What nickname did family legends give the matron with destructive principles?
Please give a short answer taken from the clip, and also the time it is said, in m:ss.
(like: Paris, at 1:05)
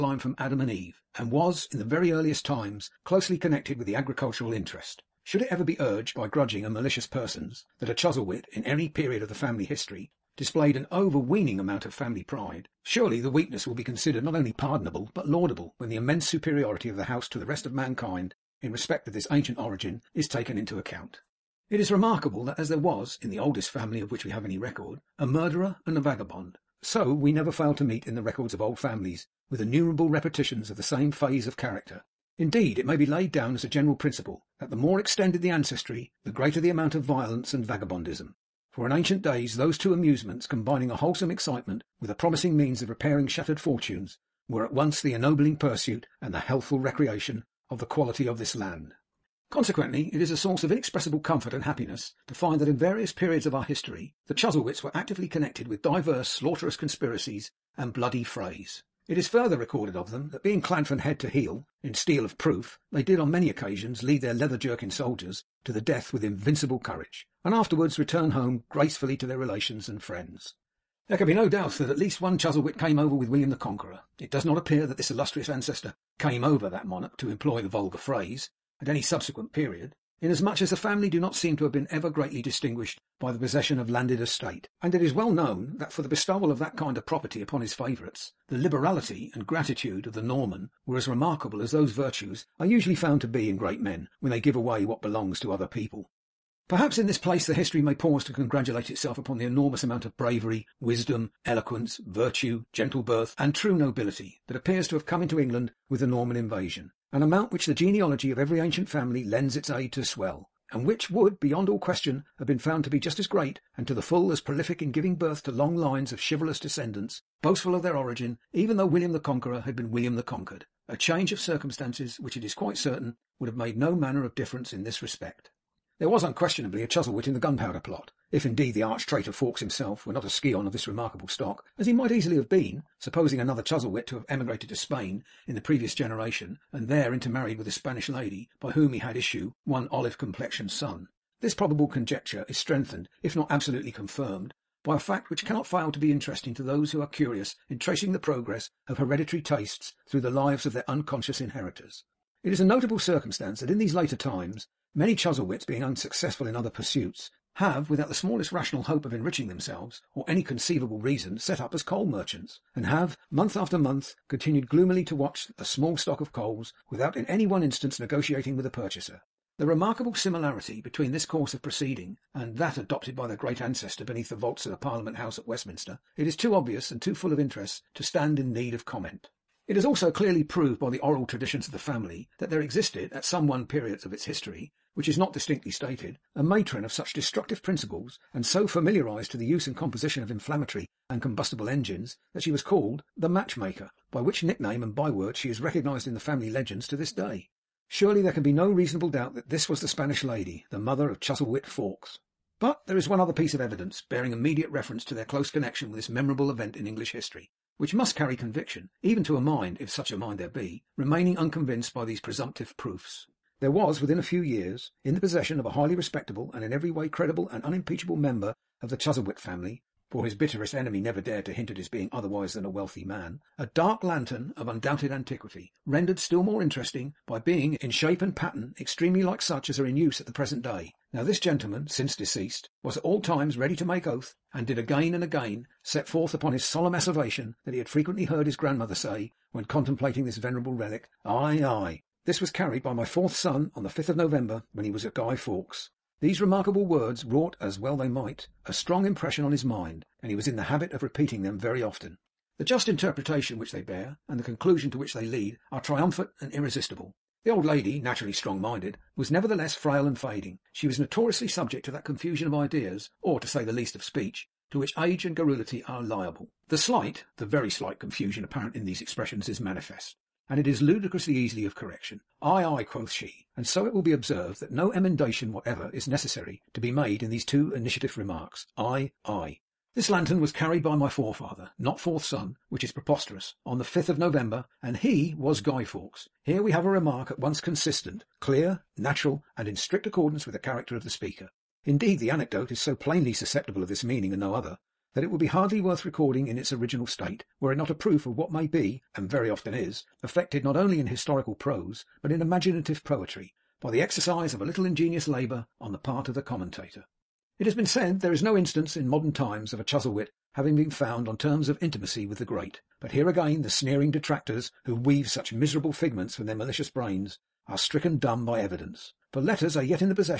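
the Match Maker, at 3:13.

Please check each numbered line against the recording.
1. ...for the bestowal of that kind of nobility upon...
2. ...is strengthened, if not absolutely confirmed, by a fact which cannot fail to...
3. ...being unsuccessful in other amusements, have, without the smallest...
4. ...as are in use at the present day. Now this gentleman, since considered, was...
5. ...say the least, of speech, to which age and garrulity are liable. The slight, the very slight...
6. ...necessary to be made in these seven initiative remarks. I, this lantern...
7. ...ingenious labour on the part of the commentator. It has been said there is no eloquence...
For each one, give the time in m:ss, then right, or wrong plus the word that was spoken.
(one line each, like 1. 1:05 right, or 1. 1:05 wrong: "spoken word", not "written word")
1. 1:25 wrong: "property", not "nobility"
2. 2:22 right
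3. 2:35 wrong: "pursuits", not "amusements"
4. 3:49 wrong: "deceased", not "considered"
5. 4:23 right
6. 4:36 wrong: "two", not "seven"
7. 5:04 wrong: "instance", not "eloquence".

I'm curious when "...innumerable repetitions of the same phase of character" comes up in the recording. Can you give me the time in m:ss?
0:29.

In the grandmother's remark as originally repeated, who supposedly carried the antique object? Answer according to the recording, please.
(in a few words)
my fourth son.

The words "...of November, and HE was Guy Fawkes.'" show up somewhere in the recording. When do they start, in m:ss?
4:44.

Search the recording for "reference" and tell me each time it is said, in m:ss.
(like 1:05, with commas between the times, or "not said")
3:24.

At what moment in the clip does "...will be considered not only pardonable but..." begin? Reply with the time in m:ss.
0:13.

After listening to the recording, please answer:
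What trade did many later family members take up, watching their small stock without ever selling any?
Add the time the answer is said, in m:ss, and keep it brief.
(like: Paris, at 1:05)
coal merchants, at 2:41.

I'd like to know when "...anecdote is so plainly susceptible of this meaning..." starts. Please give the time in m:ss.
4:52.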